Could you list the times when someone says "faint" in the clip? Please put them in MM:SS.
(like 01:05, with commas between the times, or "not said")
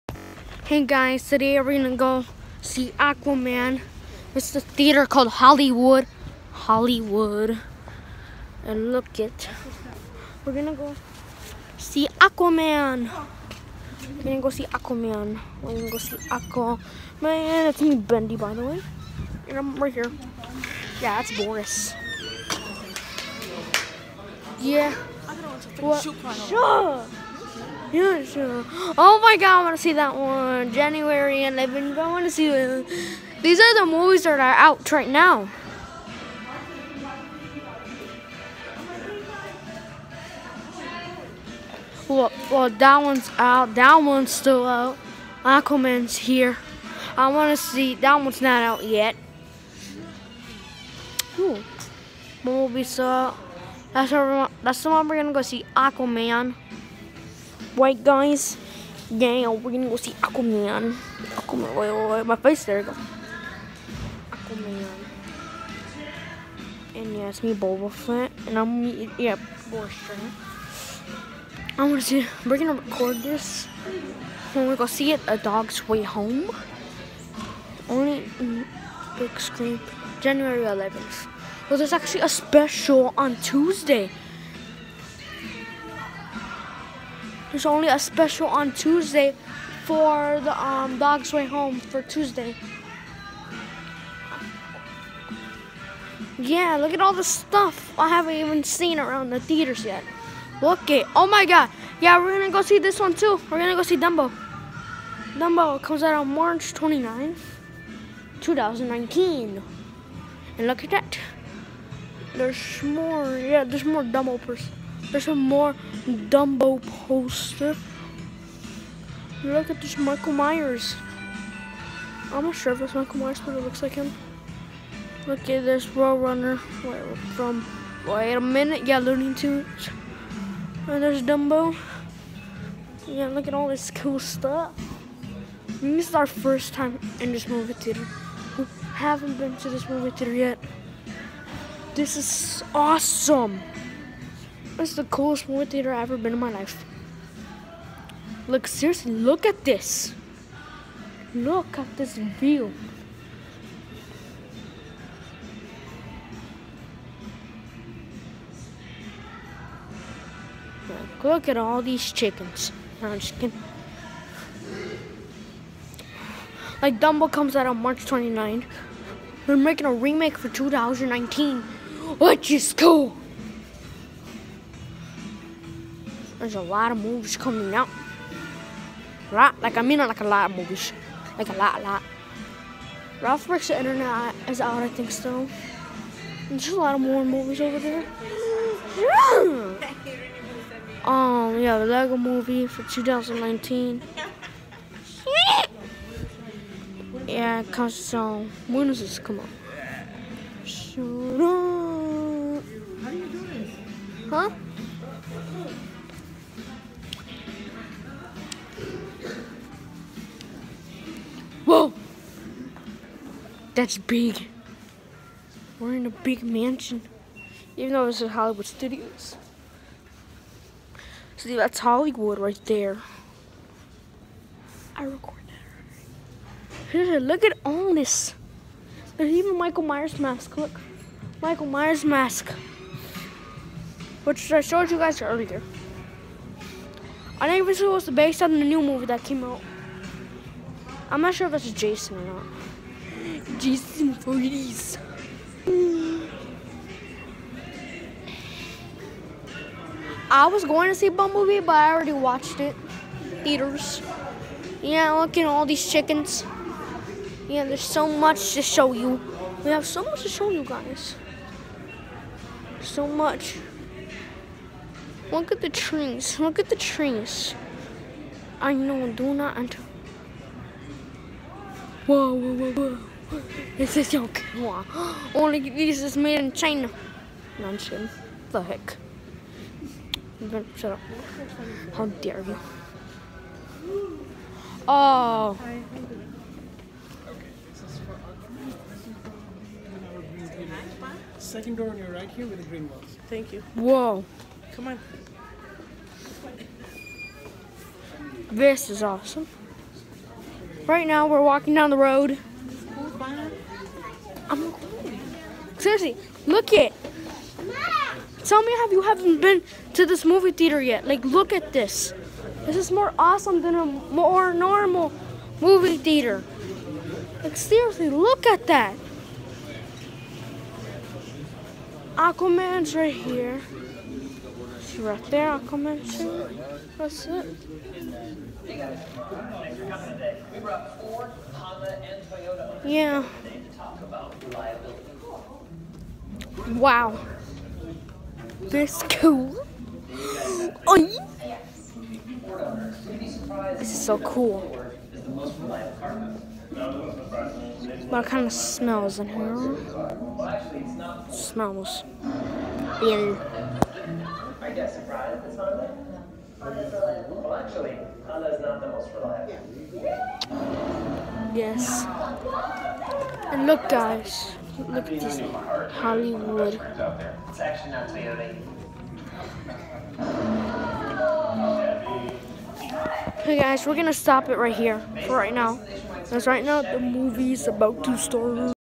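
not said.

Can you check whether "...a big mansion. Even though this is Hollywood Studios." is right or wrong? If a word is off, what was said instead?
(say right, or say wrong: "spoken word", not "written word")
right.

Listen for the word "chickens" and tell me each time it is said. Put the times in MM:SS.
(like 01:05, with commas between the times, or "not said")
02:42, 04:15.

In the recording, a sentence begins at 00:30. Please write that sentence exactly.
January 11th, I want to see it.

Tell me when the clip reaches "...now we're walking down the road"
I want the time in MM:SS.
05:01.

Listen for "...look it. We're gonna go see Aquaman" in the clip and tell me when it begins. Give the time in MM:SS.
00:08.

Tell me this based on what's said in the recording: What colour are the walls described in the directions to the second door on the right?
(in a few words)
green.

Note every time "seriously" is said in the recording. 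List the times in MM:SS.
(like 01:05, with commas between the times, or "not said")
02:28, 05:05, 05:17.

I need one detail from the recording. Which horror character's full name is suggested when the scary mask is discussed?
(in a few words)
Jason Voorhees.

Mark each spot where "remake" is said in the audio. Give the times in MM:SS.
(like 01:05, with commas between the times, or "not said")
02:49.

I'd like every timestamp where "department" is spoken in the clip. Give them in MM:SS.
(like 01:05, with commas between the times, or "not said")
not said.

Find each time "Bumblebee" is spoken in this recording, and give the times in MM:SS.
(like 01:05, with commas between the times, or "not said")
00:52, 04:11.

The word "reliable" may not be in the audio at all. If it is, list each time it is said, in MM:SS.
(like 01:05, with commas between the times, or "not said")
05:59.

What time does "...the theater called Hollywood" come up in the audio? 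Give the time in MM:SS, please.
00:04.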